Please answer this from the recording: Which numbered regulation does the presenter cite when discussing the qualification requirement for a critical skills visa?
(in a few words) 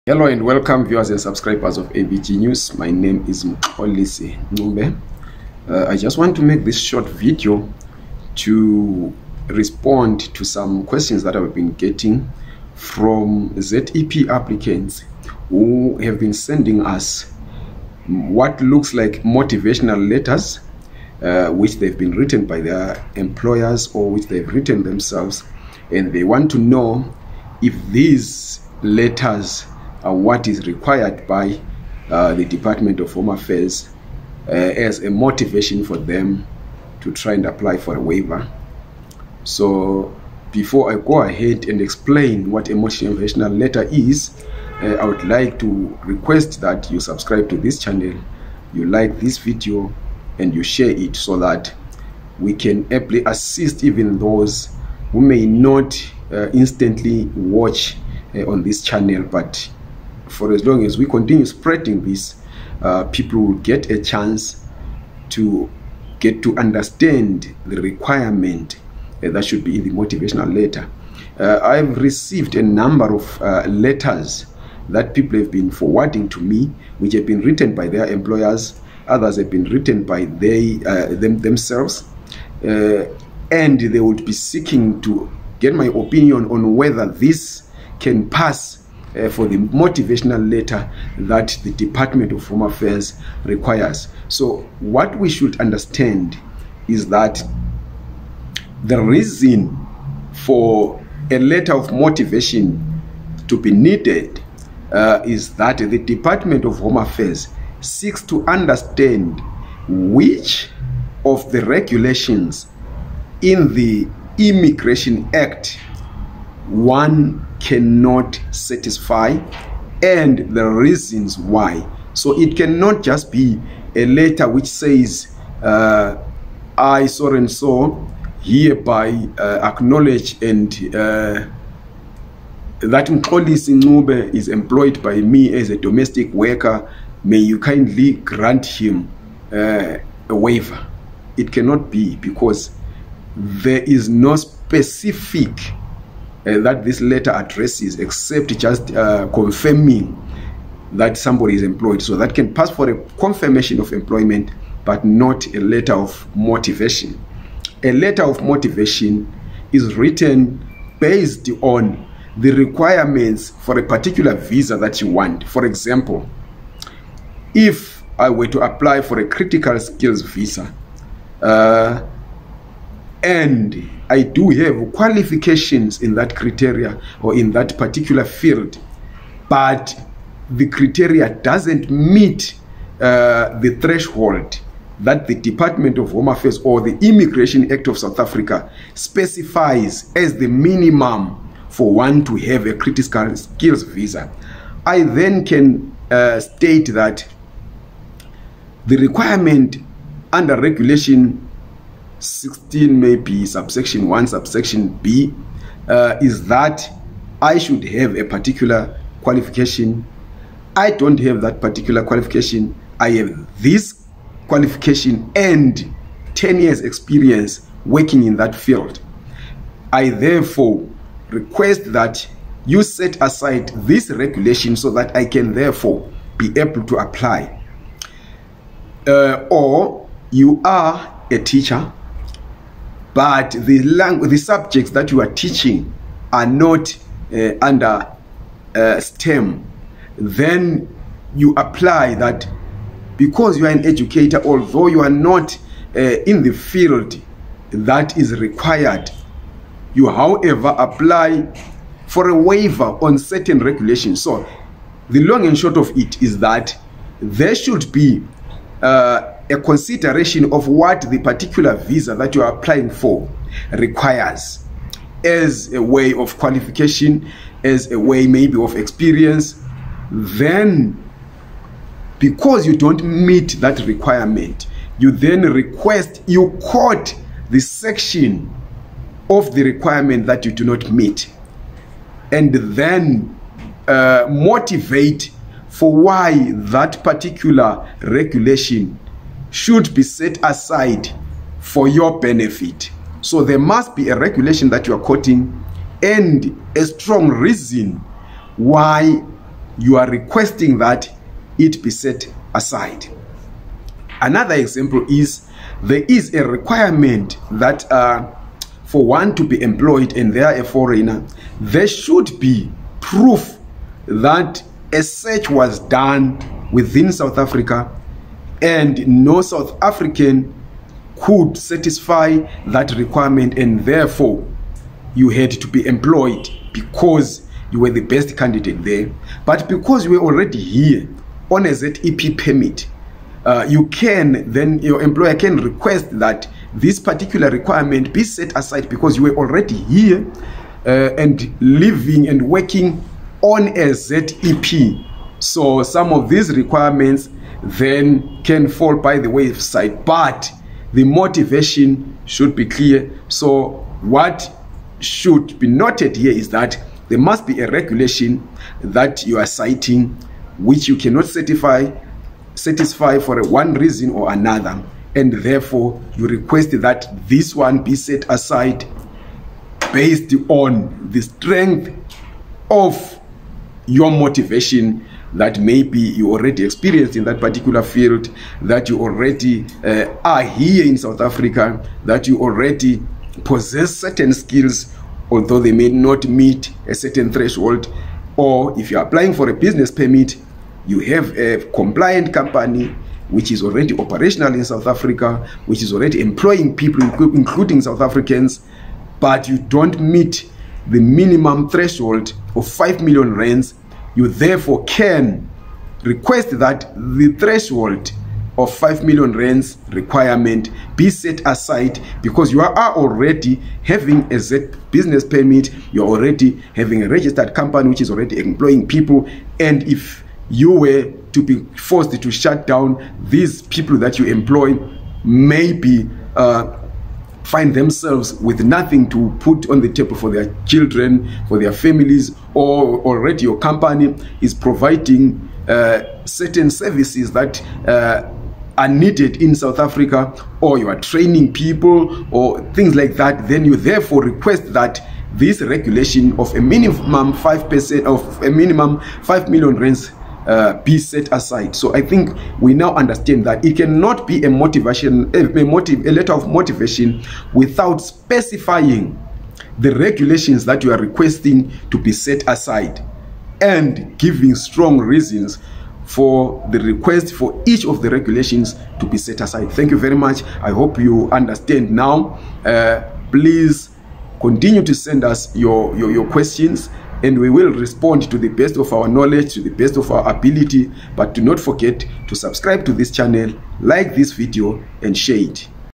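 Regulation 16.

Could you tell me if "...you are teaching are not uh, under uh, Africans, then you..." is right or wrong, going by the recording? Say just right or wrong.
wrong.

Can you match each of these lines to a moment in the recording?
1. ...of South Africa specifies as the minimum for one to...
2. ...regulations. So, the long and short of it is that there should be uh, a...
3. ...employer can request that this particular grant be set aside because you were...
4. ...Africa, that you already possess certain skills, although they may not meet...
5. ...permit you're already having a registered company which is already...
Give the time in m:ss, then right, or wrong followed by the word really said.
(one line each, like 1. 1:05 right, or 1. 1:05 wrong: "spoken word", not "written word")
1. 3:07 right
2. 4:13 right
3. 5:35 wrong: "requirement", not "grant"
4. 6:21 right
5. 6:55 right.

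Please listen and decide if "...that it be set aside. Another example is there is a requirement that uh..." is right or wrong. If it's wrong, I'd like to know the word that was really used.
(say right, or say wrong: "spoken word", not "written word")
right.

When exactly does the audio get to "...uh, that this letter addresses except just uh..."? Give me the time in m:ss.
2:26.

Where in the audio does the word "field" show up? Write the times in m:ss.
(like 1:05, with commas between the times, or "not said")
2:58, 3:38, 4:06, 6:17.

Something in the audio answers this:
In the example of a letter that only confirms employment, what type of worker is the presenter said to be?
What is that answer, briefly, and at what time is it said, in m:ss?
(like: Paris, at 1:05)
Domestic worker, at 2:15.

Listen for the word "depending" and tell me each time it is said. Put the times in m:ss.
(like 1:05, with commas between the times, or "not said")
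not said.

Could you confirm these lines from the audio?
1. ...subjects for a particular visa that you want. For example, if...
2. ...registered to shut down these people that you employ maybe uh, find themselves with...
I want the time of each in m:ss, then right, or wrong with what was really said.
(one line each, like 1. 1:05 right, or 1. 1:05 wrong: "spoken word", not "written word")
1. 2:42 wrong: "requirements", not "subjects"
2. 7:01 wrong: "forced", not "registered".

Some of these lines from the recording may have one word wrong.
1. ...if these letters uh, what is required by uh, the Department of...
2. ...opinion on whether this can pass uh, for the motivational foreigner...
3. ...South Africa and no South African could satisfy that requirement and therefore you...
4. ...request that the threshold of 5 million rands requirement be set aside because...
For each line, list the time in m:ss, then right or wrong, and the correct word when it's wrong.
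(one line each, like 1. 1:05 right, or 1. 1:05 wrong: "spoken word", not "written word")
1. 0:27 right
2. 1:25 wrong: "letter", not "foreigner"
3. 5:17 right
4. 6:46 right.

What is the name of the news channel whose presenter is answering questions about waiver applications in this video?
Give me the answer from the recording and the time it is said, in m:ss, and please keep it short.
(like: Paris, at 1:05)
AVG News, at 0:01.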